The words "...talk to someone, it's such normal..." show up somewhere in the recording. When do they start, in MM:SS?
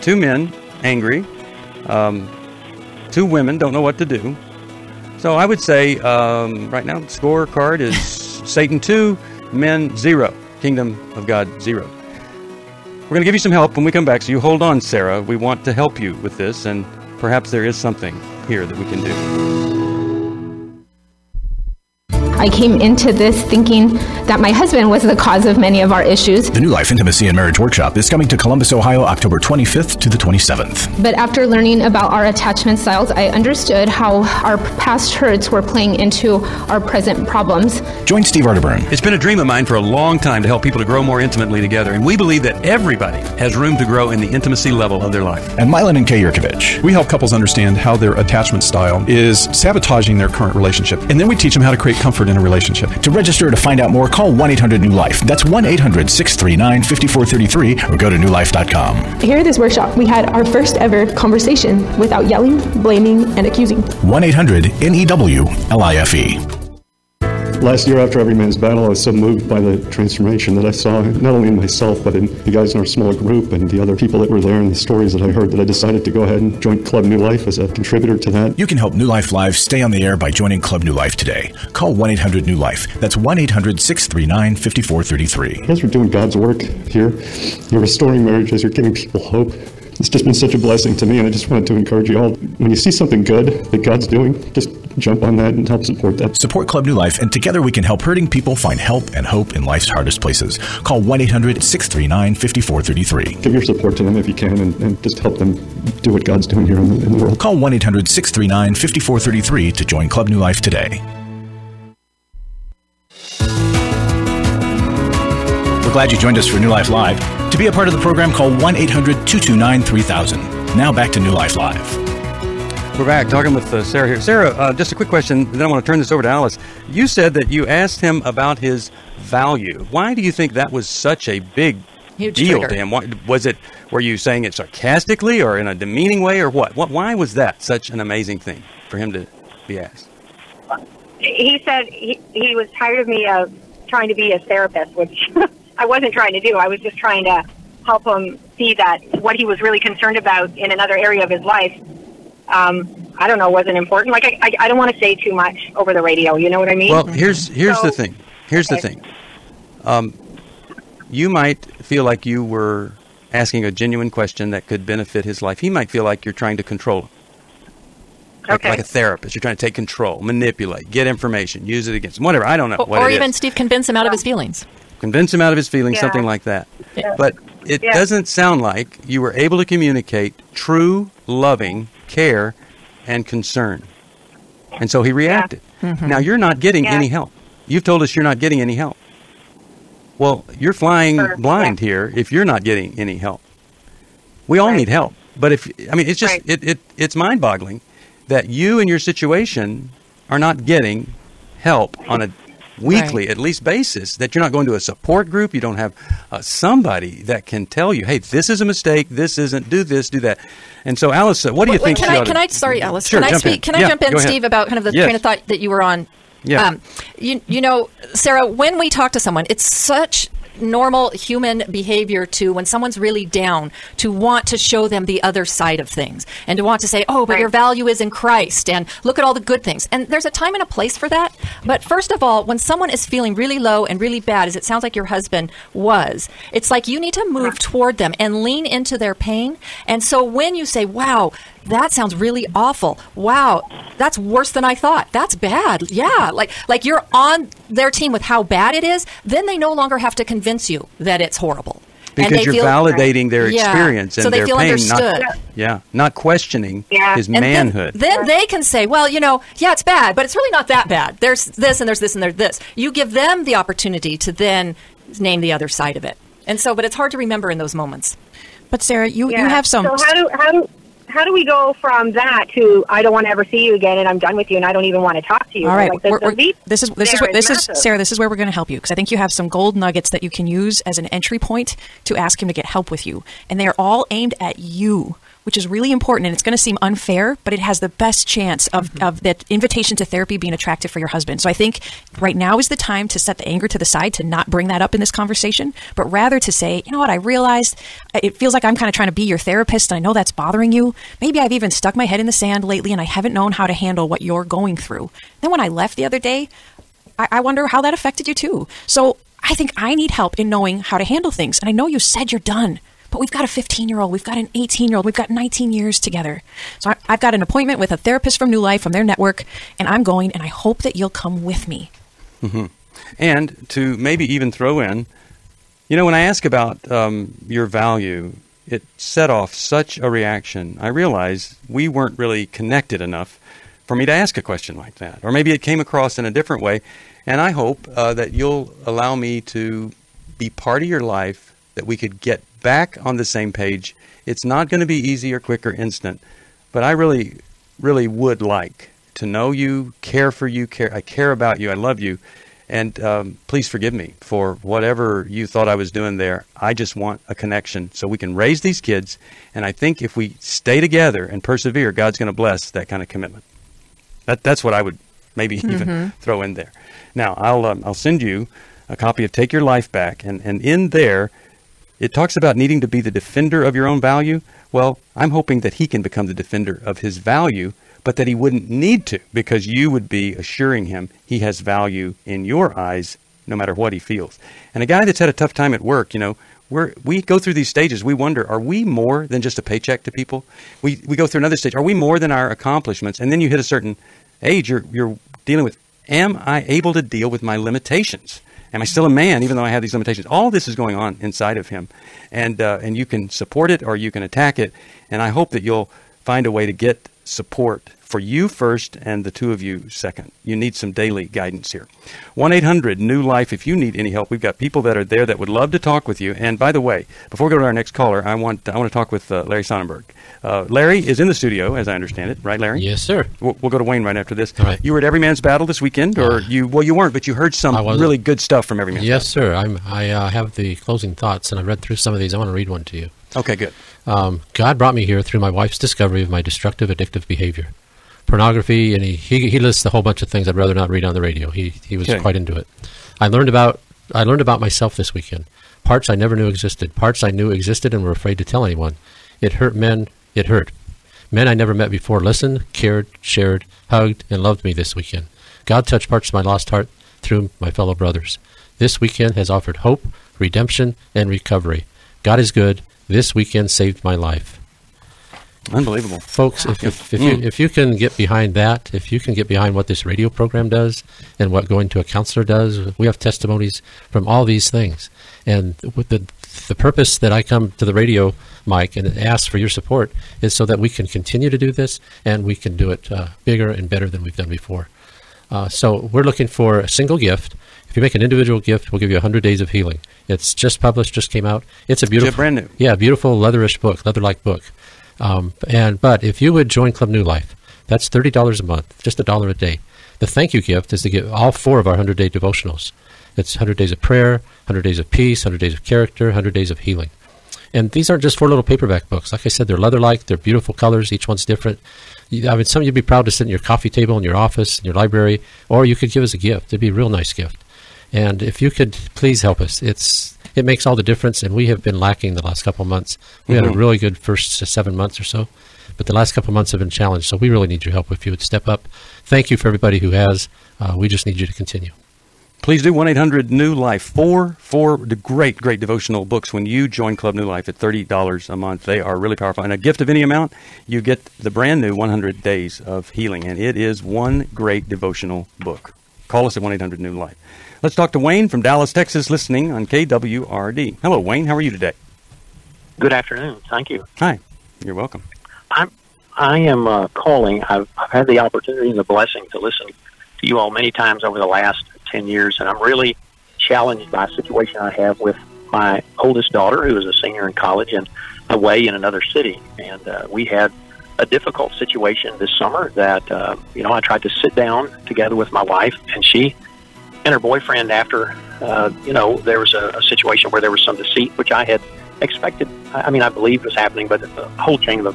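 03:38.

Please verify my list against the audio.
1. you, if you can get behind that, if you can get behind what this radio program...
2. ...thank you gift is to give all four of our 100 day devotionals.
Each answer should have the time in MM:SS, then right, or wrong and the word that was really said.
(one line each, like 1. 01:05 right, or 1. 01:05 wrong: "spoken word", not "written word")
1. 07:47 right
2. 08:20 right.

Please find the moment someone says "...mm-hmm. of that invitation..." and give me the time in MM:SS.
04:48.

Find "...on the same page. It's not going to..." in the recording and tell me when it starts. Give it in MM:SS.
05:43.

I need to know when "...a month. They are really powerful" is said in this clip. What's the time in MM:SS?
08:58.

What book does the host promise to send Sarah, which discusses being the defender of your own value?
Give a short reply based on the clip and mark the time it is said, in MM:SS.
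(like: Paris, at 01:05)
Take Your Life Back, at 06:09.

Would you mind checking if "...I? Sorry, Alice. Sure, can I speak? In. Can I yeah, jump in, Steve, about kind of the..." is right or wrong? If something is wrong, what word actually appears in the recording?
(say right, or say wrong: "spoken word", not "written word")
right.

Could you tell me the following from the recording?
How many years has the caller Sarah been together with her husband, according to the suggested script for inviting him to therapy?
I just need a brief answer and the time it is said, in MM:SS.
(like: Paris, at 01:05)
19, at 05:15.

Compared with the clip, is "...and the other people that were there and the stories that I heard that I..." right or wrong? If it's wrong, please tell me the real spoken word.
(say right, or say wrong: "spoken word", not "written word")
right.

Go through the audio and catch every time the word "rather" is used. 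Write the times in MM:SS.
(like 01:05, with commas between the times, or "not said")
04:56, 07:20.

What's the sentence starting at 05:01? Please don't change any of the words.
Maybe I've even stuck my head in the sand lately and I haven't known how to handle what you're going through.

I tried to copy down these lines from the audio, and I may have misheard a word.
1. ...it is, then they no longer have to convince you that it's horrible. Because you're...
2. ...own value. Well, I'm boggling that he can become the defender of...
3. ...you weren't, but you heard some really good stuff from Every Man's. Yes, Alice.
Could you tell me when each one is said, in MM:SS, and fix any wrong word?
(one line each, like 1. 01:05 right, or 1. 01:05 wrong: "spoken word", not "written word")
1. 04:08 right
2. 06:13 wrong: "hoping", not "boggling"
3. 07:06 wrong: "Battle", not "Alice".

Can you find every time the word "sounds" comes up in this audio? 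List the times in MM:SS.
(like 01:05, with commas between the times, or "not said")
02:58, 03:54, 04:01.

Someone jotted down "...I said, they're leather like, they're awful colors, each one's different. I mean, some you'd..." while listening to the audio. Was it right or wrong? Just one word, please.
wrong.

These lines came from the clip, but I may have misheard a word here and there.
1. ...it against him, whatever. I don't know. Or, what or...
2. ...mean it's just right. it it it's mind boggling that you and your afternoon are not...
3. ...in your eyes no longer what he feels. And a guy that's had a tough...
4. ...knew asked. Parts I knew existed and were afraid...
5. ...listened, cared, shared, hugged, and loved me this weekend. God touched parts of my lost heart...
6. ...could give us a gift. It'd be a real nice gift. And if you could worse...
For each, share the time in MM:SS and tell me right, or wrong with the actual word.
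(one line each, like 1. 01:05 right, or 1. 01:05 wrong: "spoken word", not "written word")
1. 02:51 right
2. 03:15 wrong: "situation", not "afternoon"
3. 06:22 wrong: "matter", not "longer"
4. 07:26 wrong: "existed", not "asked"
5. 07:32 right
6. 08:35 wrong: "please", not "worse".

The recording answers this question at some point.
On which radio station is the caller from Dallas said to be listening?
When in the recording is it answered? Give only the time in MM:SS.
09:09.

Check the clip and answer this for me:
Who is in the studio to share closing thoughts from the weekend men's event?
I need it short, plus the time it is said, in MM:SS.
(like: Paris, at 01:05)
Larry Sonnenberg, at 06:59.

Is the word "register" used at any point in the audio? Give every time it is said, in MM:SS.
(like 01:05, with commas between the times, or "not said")
00:53.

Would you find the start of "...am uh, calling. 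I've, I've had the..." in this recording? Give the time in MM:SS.
09:16.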